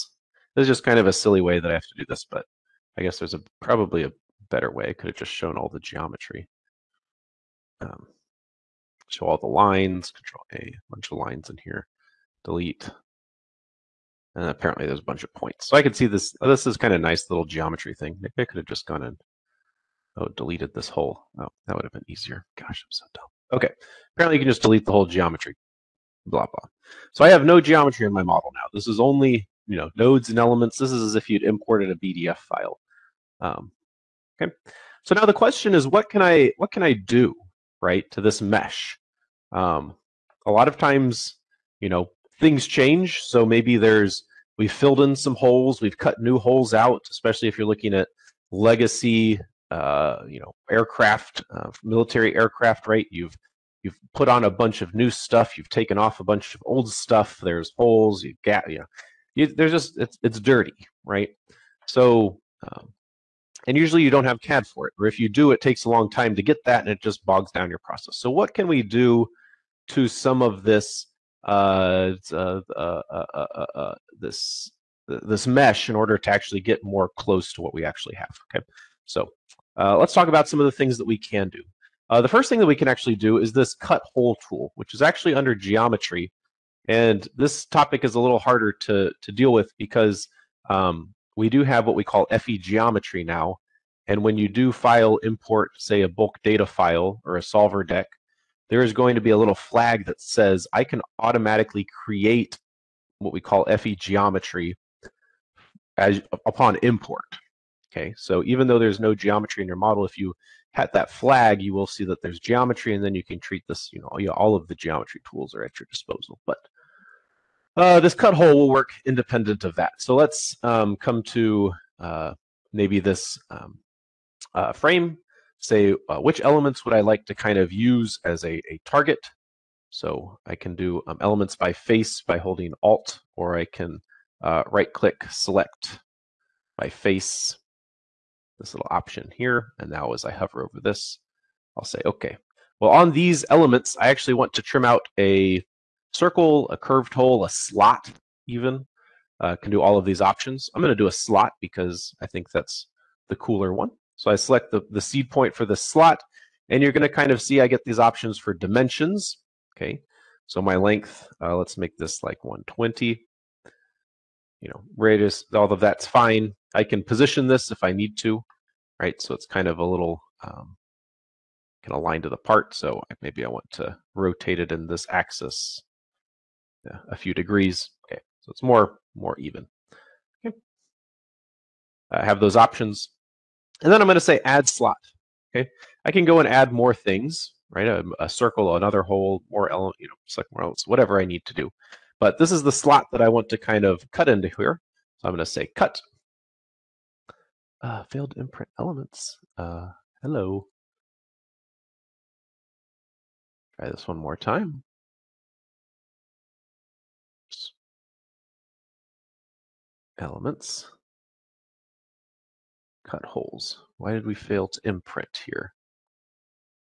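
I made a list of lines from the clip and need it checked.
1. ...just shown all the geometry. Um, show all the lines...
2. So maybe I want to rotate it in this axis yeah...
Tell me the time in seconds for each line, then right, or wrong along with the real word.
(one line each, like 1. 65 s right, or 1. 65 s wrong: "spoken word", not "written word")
1. 5 s right
2. 172 s right.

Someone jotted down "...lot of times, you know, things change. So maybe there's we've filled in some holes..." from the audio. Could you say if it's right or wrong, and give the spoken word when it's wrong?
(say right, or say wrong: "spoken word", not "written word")
right.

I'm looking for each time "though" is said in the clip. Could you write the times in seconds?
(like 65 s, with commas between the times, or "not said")
108 s.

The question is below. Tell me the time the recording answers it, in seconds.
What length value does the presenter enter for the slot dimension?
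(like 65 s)
162 s.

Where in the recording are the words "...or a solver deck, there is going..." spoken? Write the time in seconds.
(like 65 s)
97 s.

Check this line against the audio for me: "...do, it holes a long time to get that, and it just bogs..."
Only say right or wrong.
wrong.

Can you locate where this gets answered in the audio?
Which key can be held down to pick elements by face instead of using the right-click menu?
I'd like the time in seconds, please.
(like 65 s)
132 s.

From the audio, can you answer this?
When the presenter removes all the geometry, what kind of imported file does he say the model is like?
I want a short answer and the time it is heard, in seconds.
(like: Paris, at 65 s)
BDF file, at 31 s.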